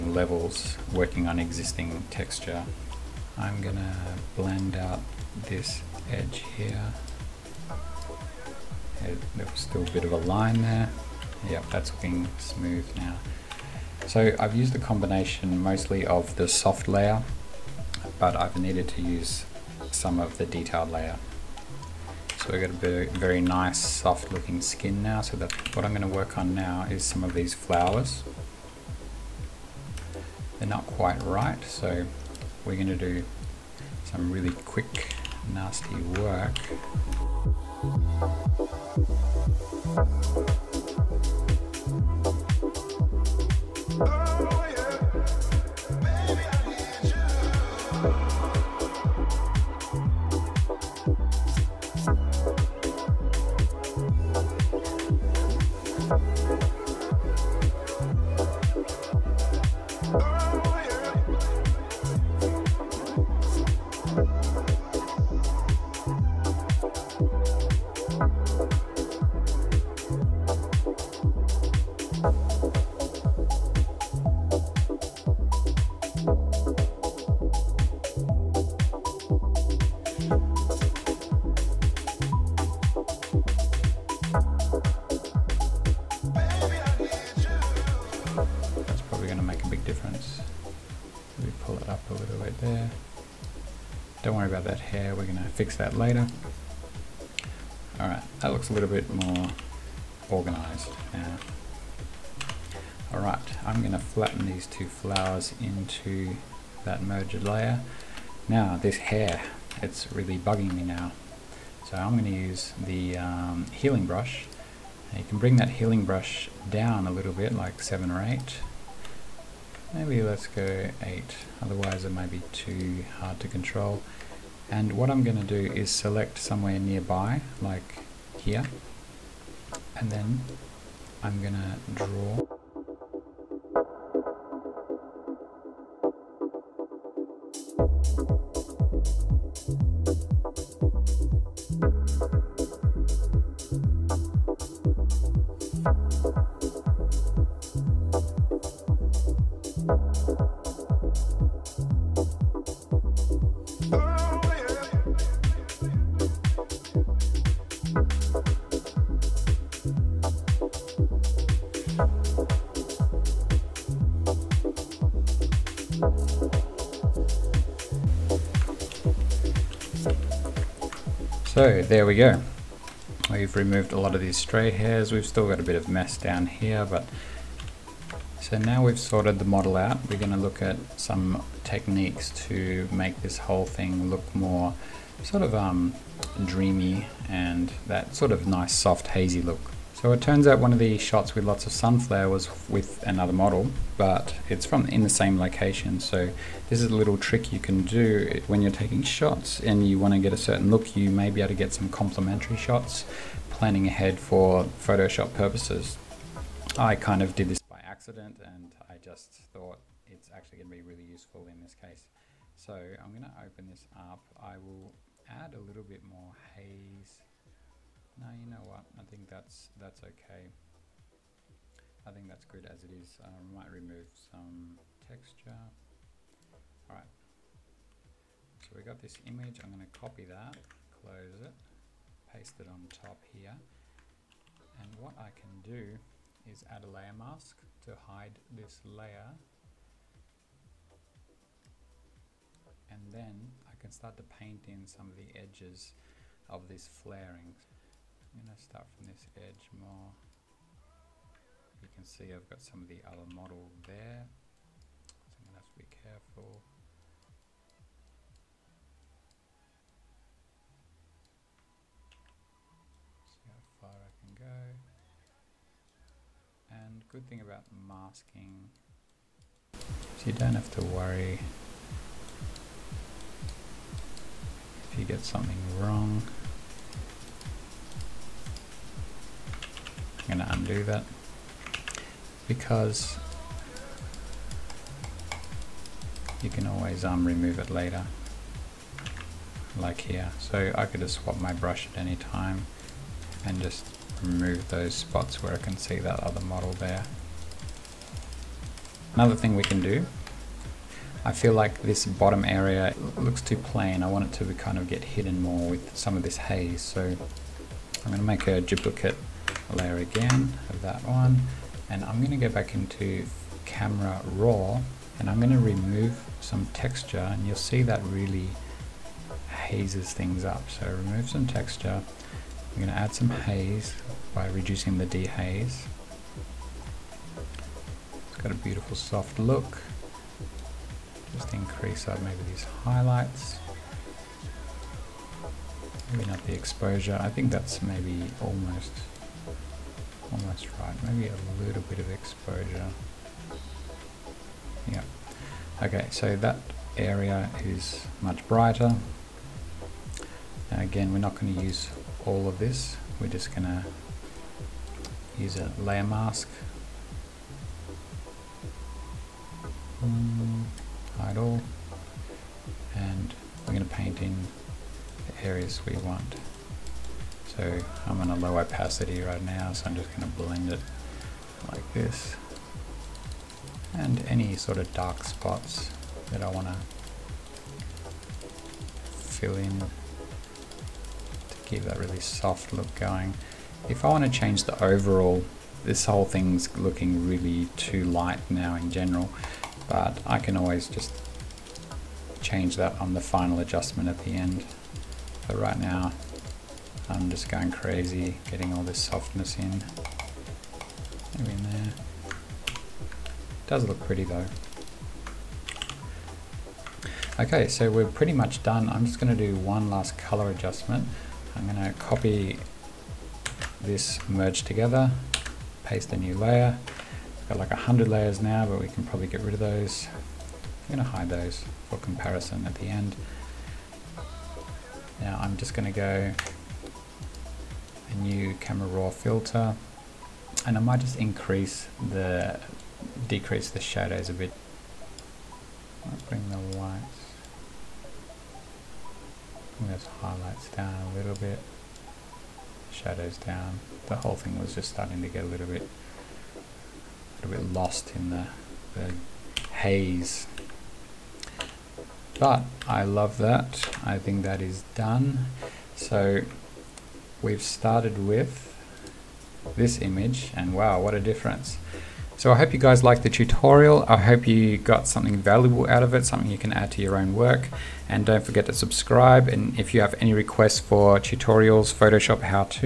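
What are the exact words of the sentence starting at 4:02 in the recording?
And then I can start to paint in some of the edges of this flaring.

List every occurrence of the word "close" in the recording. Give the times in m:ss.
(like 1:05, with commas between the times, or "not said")
3:50.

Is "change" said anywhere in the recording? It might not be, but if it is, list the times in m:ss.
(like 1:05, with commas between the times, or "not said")
6:24, 6:32.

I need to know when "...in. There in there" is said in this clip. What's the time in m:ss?
6:39.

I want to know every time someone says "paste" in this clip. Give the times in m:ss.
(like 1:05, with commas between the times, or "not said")
3:52, 6:55.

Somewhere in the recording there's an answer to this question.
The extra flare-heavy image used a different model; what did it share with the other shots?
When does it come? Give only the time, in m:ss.
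3:14.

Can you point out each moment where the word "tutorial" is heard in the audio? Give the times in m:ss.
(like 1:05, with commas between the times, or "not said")
7:43, 7:51.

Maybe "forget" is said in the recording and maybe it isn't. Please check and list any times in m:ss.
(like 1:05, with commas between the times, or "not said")
7:48.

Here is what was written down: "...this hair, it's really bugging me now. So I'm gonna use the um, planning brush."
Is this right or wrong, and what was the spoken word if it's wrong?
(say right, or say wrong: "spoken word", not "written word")
wrong: "healing", not "planning".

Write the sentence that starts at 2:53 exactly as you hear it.
We've removed a lot of these stray hairs.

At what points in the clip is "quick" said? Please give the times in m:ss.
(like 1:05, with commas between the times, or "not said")
0:34.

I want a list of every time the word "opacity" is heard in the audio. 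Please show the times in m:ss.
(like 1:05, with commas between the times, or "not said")
6:08.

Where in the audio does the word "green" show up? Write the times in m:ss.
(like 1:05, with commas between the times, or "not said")
not said.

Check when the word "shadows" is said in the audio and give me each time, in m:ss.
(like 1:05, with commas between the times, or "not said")
7:13, 7:22.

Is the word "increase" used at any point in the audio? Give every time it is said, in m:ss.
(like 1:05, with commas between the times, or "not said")
5:31, 7:11.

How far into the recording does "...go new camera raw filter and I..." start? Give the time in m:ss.
7:05.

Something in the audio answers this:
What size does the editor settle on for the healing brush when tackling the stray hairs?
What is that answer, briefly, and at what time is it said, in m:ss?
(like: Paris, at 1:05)
8, at 1:59.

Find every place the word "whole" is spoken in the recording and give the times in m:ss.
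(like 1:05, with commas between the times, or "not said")
3:03, 6:26, 7:24.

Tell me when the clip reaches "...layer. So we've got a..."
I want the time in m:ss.
0:20.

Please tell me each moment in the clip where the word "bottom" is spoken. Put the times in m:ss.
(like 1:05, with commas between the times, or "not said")
5:02.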